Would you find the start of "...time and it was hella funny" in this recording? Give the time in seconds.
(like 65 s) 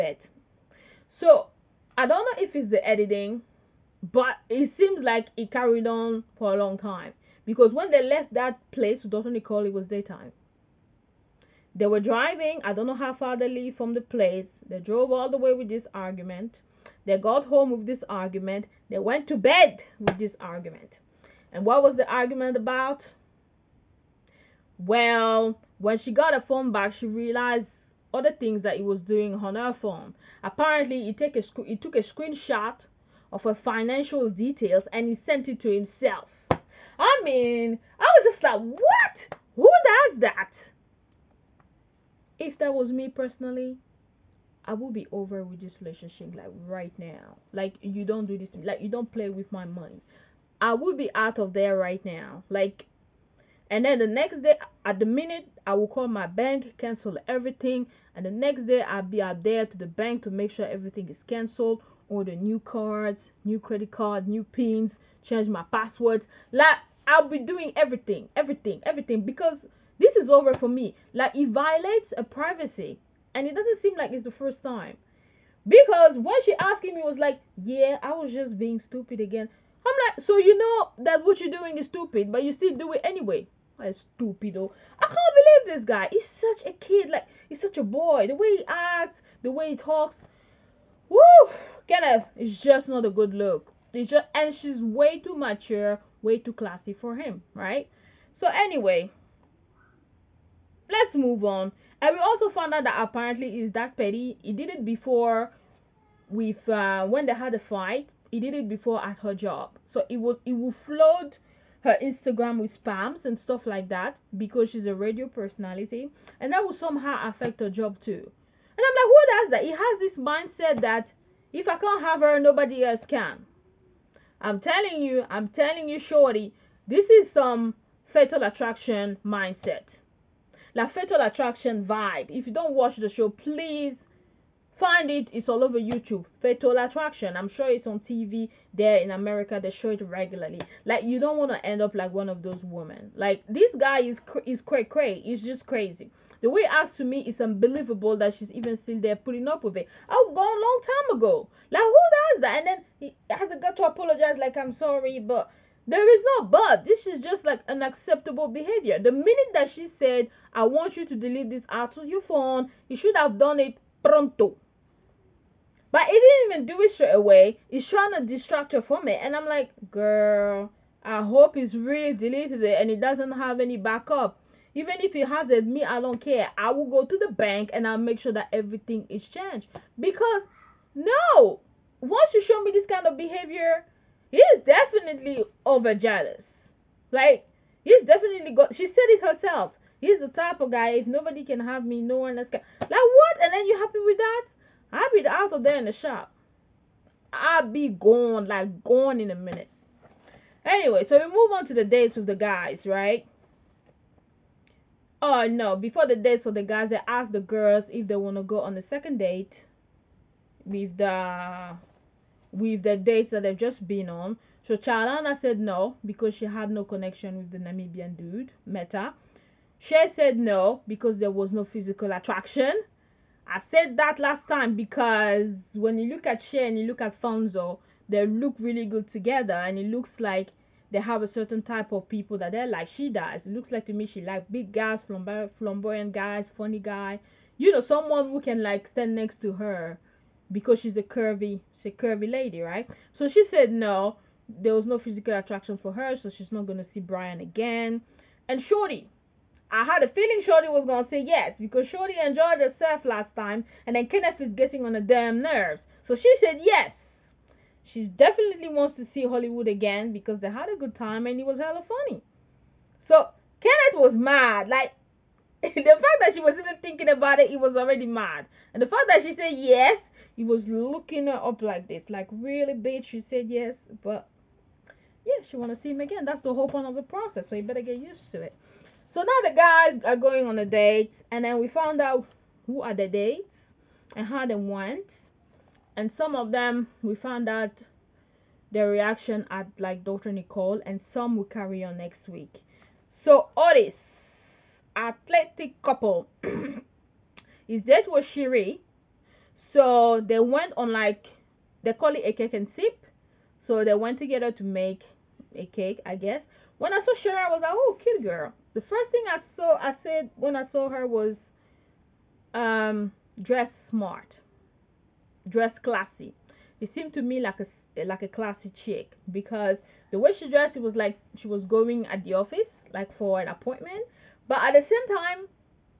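260 s.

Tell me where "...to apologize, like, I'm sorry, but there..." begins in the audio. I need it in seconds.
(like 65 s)
153 s.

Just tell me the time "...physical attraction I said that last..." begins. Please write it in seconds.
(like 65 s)
221 s.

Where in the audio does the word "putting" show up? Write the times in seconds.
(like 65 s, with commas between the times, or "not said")
149 s.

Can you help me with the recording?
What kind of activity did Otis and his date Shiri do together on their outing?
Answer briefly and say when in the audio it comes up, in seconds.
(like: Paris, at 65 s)
Cake and sip, at 302 s.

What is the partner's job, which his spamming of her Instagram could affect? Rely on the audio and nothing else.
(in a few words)
Radio personality.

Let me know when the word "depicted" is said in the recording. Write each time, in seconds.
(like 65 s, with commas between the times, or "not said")
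not said.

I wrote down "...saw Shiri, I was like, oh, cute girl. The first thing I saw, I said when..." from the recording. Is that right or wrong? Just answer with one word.
right.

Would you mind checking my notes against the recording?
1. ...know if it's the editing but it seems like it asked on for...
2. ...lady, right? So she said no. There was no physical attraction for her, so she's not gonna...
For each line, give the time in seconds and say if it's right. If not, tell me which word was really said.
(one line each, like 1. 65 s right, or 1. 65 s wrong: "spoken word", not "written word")
1. 2 s wrong: "carried", not "asked"
2. 242 s right.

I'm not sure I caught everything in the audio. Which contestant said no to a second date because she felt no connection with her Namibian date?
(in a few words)
Charlana.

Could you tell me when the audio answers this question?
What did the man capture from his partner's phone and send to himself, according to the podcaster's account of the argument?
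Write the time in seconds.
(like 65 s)
33 s.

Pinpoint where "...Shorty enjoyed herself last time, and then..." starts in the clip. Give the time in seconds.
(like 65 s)
251 s.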